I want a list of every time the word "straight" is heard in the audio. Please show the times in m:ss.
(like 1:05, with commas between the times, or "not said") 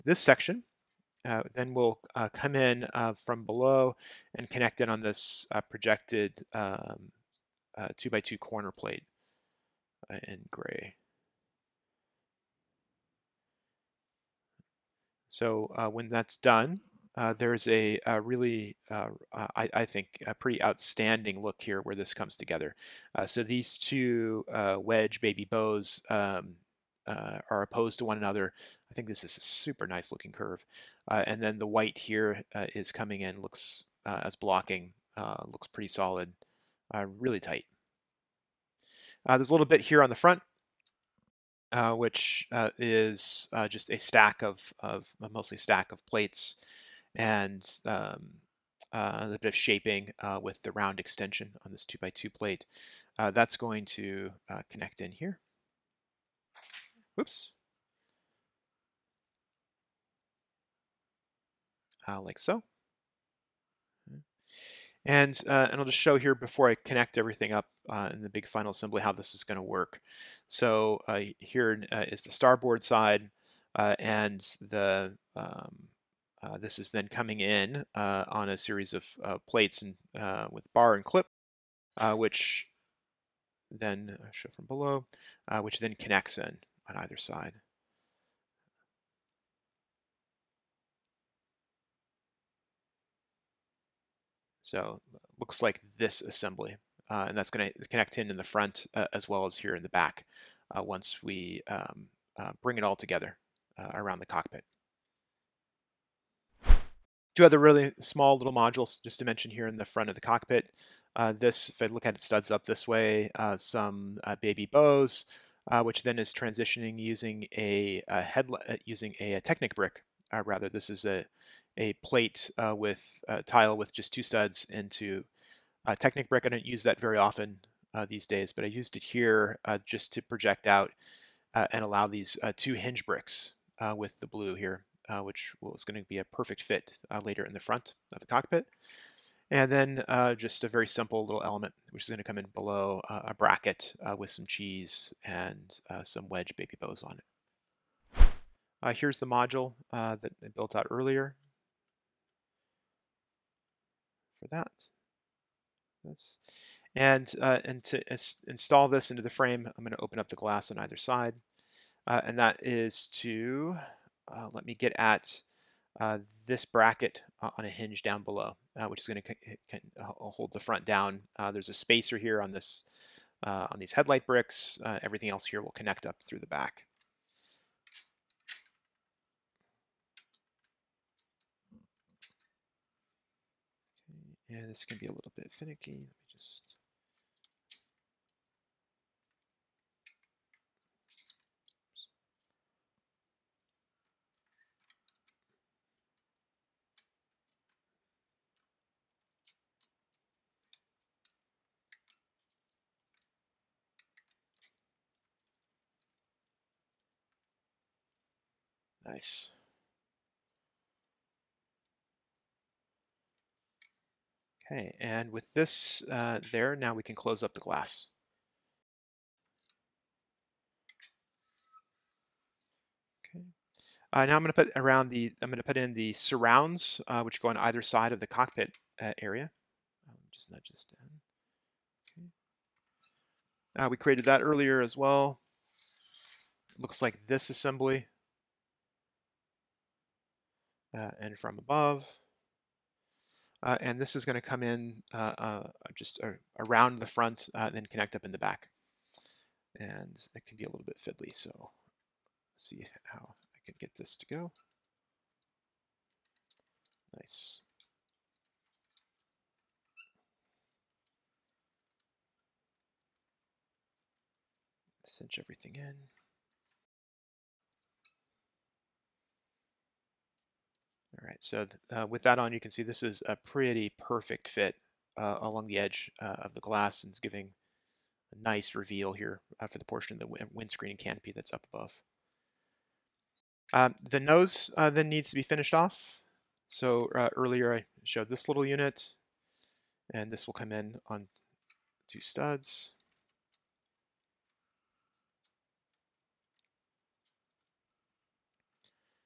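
not said.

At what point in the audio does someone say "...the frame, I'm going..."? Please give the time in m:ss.
2:39.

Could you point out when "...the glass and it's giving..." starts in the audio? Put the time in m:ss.
4:36.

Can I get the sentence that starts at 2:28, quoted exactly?
Uh, here's the module uh, that I built out earlier for that.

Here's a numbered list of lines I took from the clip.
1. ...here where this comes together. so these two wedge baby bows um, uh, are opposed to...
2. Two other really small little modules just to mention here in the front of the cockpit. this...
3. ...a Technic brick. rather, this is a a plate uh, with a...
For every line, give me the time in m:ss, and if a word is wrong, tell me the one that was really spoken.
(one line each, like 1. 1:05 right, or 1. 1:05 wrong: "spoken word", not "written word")
1. 0:21 right
2. 1:47 right
3. 1:59 right.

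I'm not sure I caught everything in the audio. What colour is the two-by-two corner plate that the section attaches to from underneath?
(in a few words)
Gray.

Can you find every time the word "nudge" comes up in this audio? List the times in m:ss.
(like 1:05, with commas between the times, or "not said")
3:50.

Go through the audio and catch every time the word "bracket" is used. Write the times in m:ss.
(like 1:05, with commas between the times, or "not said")
2:23, 2:46.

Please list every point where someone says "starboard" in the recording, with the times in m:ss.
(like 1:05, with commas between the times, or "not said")
1:12.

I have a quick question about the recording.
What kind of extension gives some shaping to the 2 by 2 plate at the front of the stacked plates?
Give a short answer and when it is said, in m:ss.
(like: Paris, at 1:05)
Round extension, at 0:50.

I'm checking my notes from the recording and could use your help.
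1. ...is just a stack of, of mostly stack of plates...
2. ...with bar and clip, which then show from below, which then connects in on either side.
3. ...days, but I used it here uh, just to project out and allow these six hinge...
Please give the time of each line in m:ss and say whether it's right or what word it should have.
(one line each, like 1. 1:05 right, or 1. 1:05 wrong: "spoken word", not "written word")
1. 0:42 right
2. 1:20 right
3. 2:08 wrong: "two", not "six".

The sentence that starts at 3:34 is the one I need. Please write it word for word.
Okay, and with this uh, there, now we can close up the glass.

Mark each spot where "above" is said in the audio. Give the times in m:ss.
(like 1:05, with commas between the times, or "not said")
4:01, 4:41.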